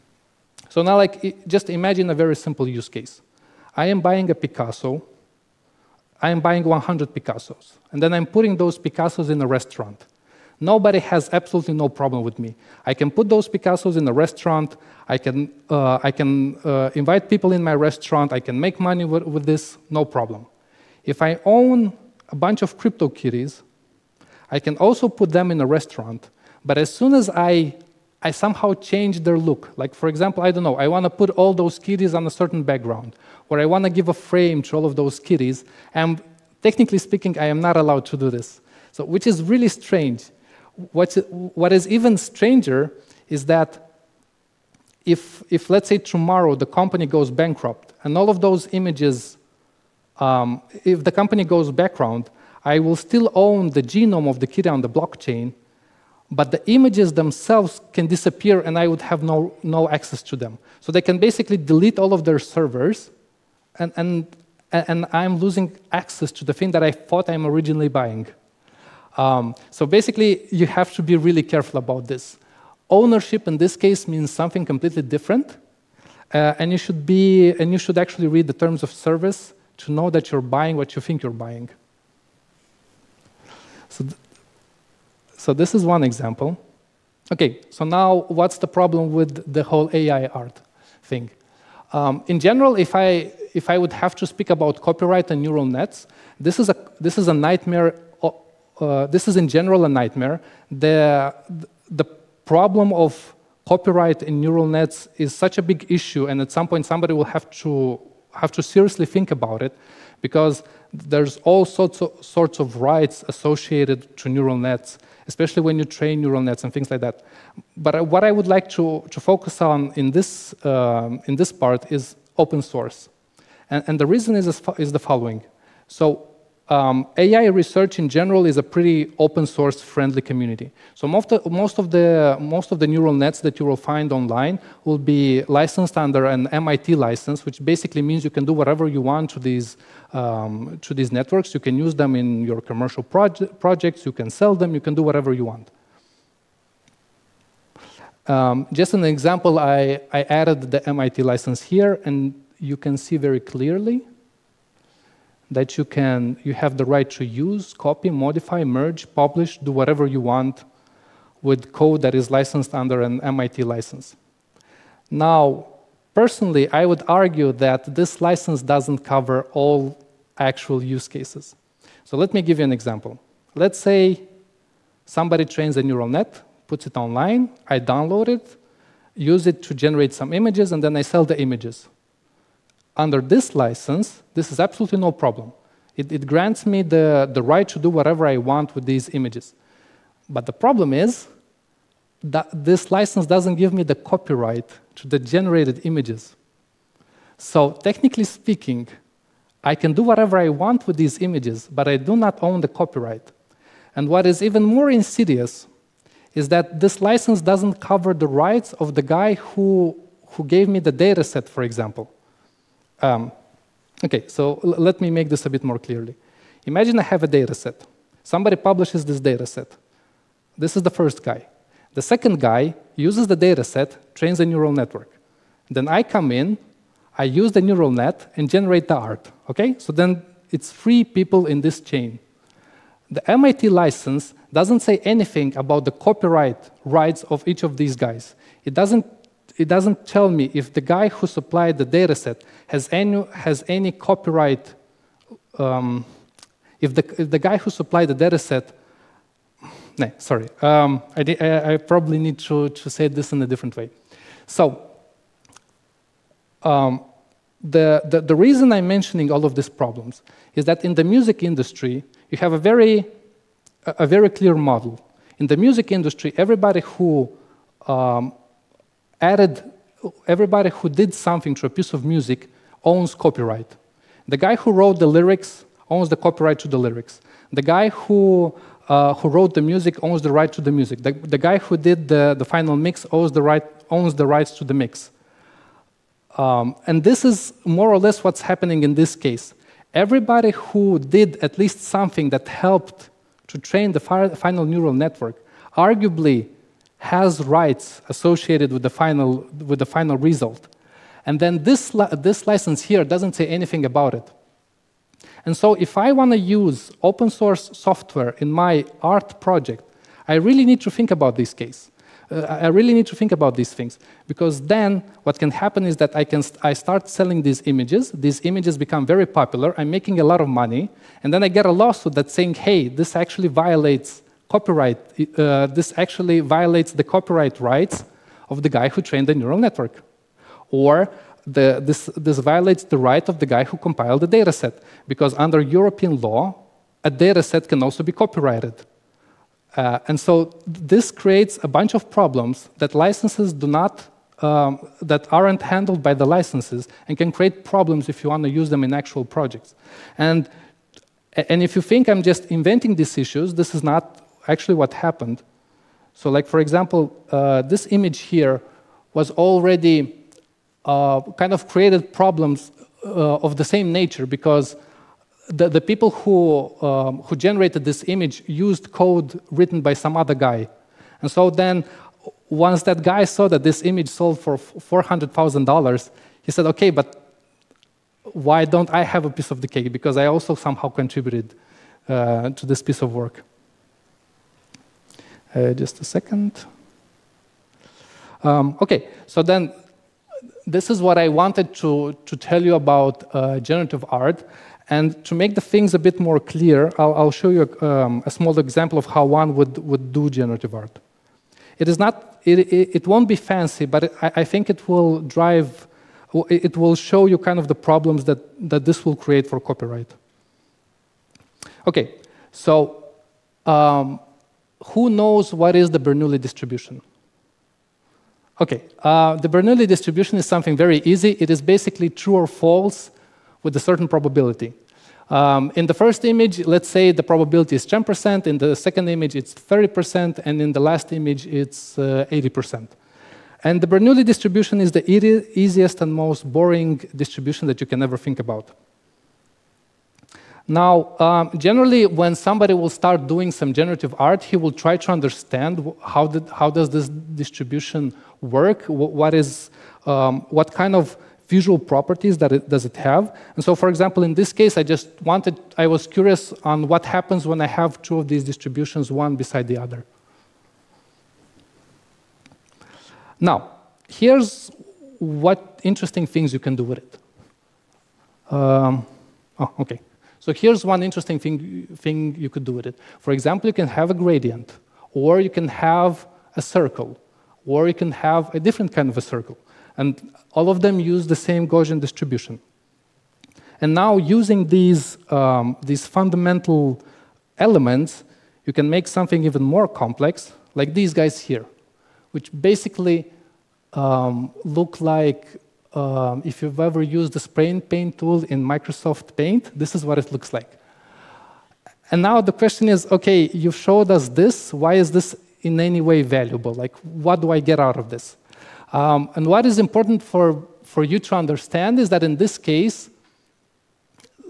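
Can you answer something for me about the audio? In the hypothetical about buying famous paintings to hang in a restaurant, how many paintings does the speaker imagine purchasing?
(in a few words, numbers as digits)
100.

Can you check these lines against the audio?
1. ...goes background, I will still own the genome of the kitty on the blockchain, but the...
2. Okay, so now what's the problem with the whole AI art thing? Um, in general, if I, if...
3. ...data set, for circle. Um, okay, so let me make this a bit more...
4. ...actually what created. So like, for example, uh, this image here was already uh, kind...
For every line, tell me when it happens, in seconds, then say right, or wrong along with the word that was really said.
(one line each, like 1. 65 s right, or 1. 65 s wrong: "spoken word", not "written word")
1. 51 s right
2. 87 s right
3. 210 s wrong: "example", not "circle"
4. 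354 s wrong: "happened", not "created".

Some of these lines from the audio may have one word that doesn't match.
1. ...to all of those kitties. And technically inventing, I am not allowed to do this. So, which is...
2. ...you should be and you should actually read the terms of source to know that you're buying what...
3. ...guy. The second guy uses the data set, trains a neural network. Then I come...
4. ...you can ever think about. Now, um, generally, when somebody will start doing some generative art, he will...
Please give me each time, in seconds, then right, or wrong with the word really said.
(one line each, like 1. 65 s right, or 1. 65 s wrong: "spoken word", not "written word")
1. 34 s wrong: "speaking", not "inventing"
2. 76 s wrong: "service", not "source"
3. 221 s right
4. 437 s right.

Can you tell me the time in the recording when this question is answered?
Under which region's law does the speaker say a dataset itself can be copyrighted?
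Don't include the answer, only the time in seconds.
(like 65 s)
335 s.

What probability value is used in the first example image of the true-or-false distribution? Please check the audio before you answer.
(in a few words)
10%.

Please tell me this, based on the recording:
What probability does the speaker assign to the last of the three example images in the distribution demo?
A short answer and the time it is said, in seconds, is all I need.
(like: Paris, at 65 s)
80%, at 432 s.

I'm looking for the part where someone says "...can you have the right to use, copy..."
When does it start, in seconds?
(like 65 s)
155 s.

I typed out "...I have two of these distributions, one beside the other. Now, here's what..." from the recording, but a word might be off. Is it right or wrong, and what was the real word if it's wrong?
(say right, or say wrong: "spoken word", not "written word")
right.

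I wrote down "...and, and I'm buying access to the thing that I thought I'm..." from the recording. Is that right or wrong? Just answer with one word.
wrong.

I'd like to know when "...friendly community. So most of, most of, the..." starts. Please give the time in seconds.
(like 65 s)
129 s.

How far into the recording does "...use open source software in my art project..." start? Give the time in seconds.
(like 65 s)
306 s.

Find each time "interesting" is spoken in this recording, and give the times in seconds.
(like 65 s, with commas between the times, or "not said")
465 s, 471 s.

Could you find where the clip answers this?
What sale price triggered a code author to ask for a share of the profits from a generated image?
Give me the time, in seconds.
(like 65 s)
374 s.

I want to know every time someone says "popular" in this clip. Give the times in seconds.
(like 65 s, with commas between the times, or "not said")
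319 s.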